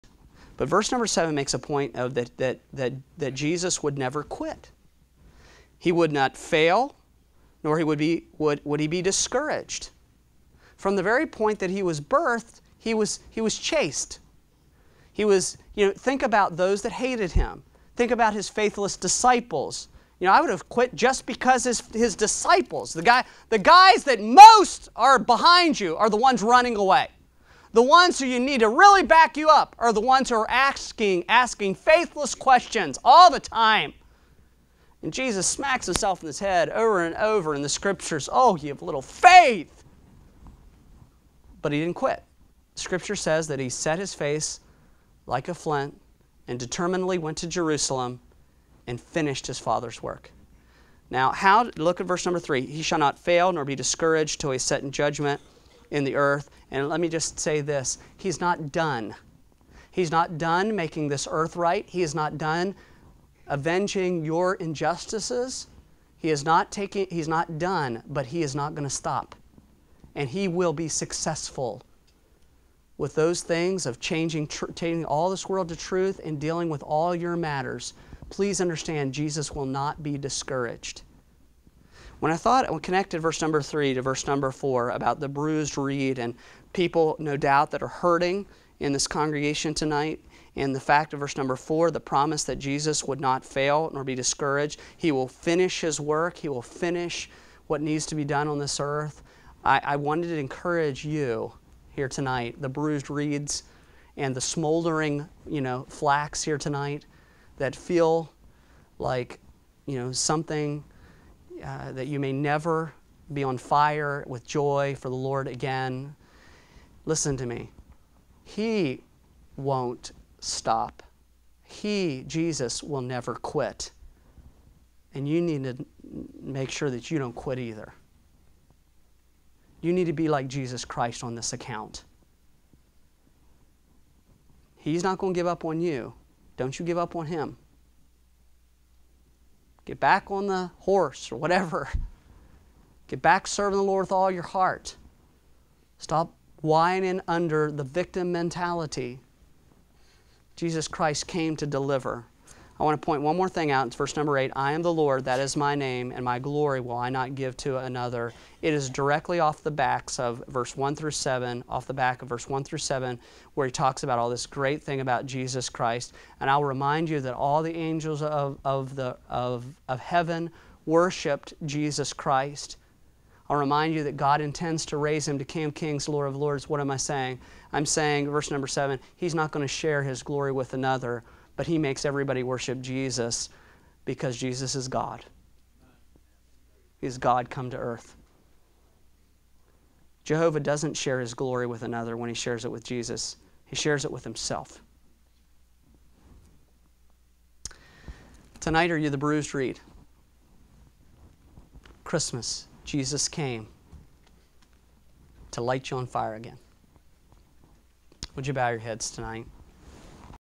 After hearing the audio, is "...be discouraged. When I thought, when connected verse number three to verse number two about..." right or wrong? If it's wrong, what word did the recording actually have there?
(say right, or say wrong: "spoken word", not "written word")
wrong: "four", not "two".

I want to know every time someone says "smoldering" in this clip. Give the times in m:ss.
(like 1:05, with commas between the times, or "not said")
1:44.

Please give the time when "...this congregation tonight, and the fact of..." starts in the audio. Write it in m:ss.
1:28.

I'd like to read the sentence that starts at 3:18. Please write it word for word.
Tonight, are you the bruised reed?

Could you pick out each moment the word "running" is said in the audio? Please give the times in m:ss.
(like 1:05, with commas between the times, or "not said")
0:26.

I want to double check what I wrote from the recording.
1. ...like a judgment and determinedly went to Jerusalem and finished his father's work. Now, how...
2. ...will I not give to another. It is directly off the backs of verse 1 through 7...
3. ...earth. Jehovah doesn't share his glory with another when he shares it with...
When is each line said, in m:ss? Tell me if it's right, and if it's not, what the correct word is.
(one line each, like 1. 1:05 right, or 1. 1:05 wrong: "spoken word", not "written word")
1. 0:45 wrong: "flint", not "judgment"
2. 2:36 right
3. 3:07 right.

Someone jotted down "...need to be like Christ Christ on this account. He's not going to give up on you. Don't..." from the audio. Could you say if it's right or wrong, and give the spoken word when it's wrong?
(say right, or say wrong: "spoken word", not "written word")
wrong: "Jesus", not "Christ".